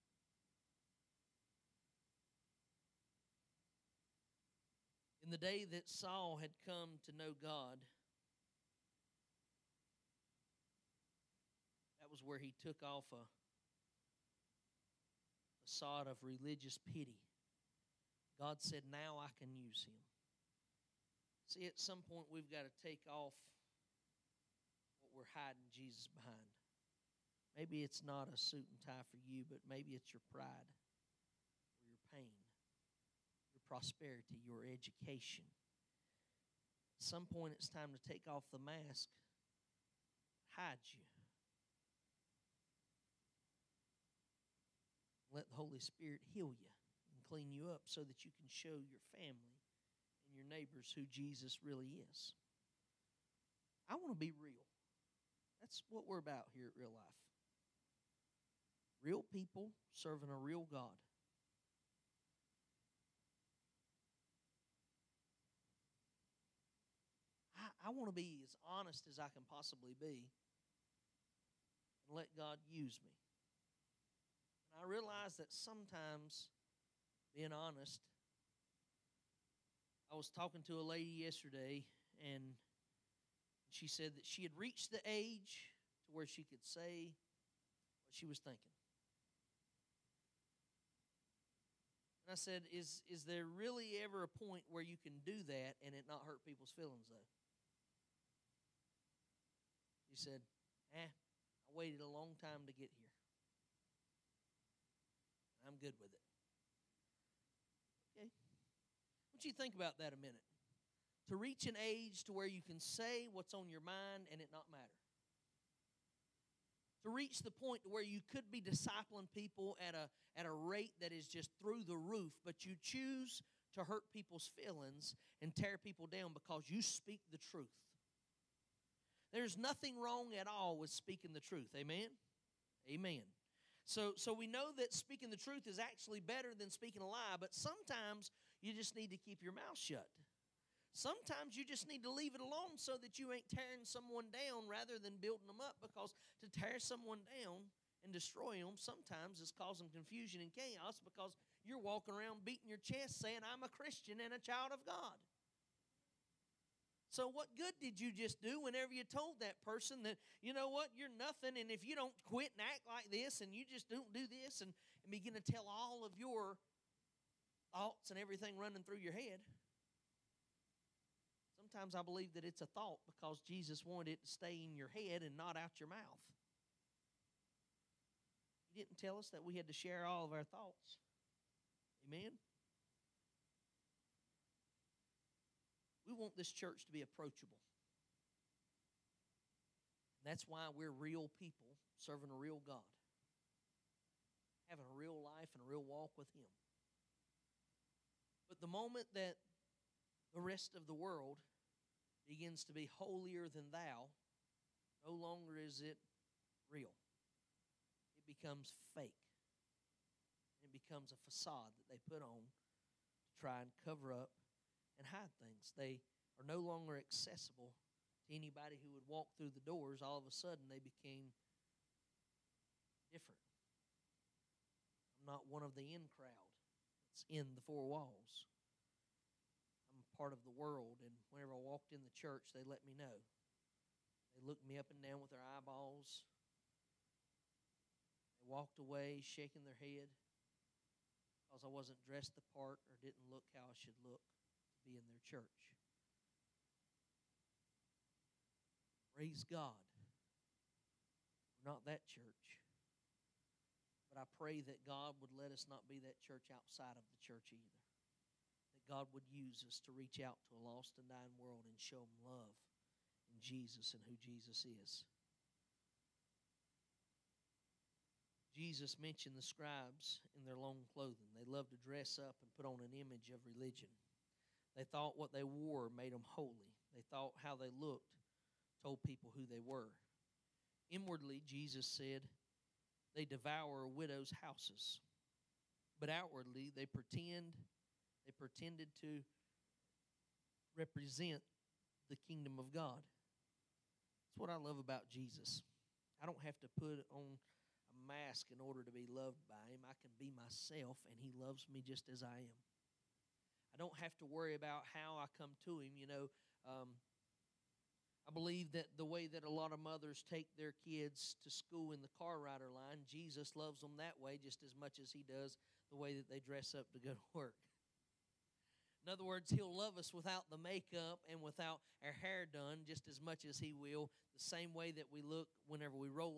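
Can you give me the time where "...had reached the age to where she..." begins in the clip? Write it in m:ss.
1:24.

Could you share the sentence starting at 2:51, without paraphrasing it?
Sometimes I believe that it's a thought because Jesus wanted it to stay in your head and not out your mouth.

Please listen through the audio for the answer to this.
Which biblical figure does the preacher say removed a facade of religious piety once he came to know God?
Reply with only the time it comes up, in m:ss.
0:05.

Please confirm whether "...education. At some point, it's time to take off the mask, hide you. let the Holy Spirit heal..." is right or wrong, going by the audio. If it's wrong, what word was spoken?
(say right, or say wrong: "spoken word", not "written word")
right.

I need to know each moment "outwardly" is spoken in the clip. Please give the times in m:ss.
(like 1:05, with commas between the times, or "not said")
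4:46.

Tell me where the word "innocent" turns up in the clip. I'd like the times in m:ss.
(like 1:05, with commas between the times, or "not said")
not said.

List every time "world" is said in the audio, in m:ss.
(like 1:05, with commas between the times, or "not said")
3:20, 3:50, 4:21.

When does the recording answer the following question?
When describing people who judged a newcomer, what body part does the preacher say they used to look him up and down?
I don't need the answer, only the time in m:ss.
3:55.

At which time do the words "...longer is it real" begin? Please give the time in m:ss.
3:25.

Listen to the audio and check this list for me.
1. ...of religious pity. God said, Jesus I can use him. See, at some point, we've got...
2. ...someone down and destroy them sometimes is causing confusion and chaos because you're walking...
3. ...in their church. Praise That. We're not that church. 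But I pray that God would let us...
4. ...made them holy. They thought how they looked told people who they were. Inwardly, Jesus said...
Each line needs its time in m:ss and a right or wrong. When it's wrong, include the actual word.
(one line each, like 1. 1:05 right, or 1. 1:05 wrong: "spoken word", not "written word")
1. 0:16 wrong: "Now", not "Jesus"
2. 2:26 right
3. 4:04 wrong: "God", not "That"
4. 4:35 right.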